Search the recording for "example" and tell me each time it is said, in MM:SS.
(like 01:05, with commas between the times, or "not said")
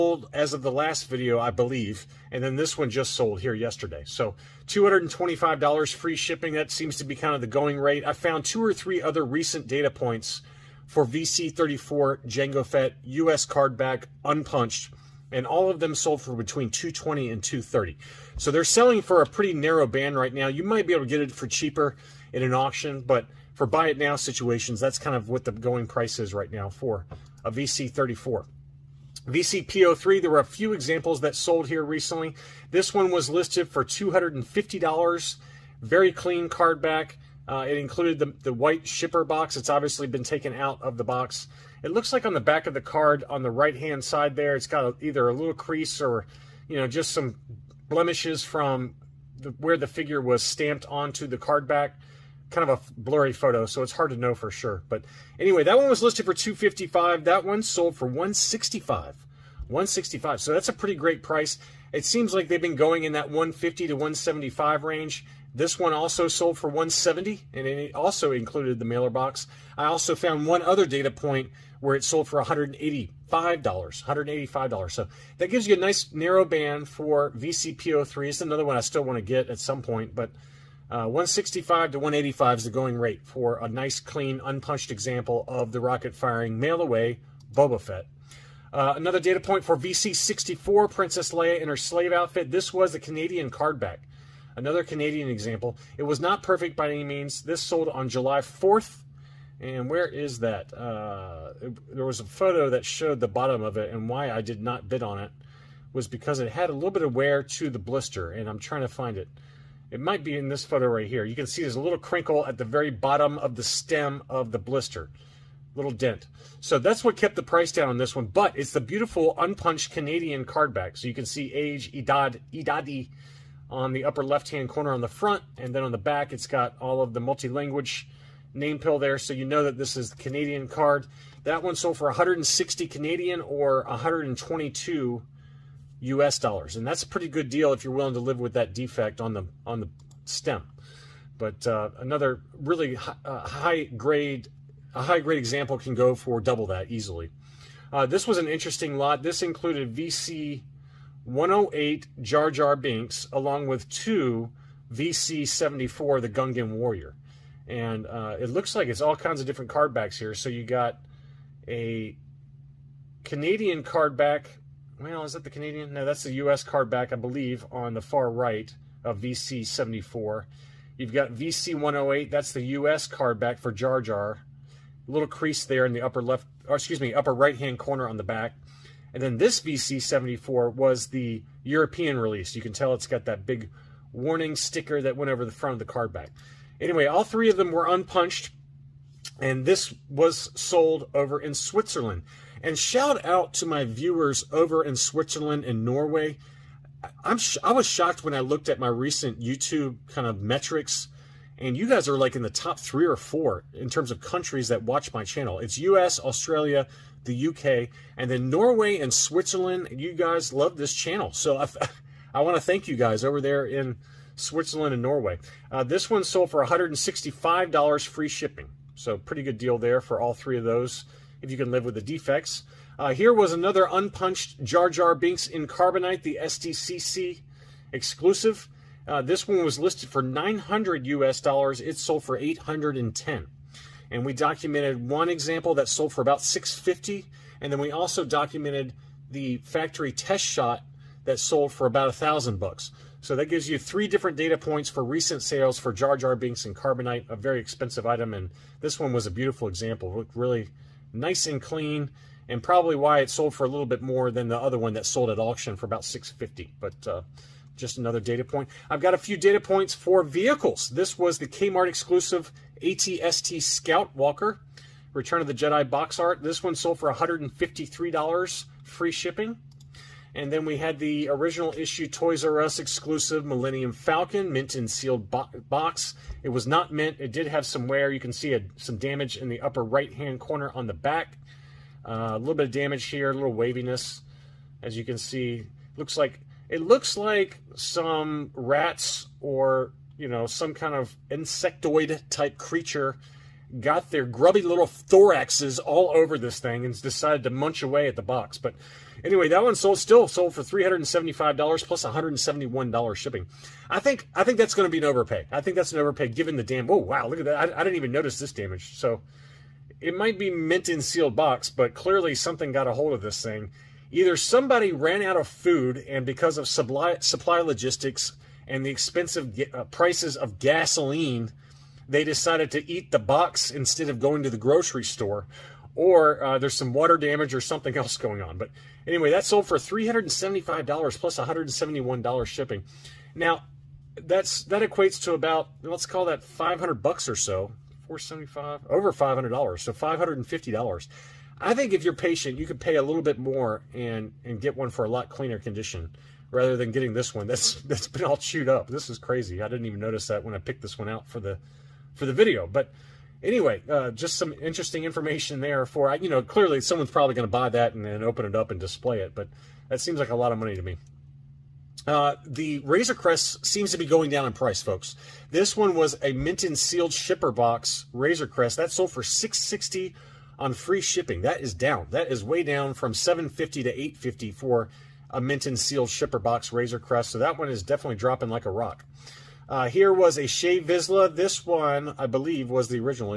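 00:30, 01:24, 01:35, 02:25, 03:55, 04:09.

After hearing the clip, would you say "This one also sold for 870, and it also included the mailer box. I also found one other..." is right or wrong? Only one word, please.
wrong.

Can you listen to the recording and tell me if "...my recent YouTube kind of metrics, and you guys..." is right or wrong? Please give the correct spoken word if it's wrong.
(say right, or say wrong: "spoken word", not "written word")
right.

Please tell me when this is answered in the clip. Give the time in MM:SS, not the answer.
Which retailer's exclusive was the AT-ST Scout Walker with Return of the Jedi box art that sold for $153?
04:21.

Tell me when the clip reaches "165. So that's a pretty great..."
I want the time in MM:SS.
00:59.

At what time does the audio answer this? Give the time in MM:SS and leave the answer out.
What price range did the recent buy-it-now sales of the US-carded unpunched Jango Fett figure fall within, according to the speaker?
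00:16.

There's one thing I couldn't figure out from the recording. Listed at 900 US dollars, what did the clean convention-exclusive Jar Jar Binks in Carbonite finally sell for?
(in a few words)
810.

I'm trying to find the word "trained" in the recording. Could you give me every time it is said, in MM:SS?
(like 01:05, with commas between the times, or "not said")
not said.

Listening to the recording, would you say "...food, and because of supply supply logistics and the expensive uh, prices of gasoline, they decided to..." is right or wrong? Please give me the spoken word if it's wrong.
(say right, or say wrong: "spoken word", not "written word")
right.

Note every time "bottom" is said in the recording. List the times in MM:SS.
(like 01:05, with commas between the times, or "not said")
01:43, 01:52.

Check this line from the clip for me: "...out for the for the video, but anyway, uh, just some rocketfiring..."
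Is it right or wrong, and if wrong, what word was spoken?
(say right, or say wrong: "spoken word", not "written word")
wrong: "interesting", not "rocketfiring".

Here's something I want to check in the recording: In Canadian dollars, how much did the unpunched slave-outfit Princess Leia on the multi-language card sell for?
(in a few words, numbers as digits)
160.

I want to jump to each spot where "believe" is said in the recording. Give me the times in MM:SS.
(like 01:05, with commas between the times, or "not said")
00:01, 02:47, 06:22.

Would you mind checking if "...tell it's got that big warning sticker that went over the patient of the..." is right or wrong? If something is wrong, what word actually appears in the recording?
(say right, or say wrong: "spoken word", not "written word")
wrong: "front", not "patient".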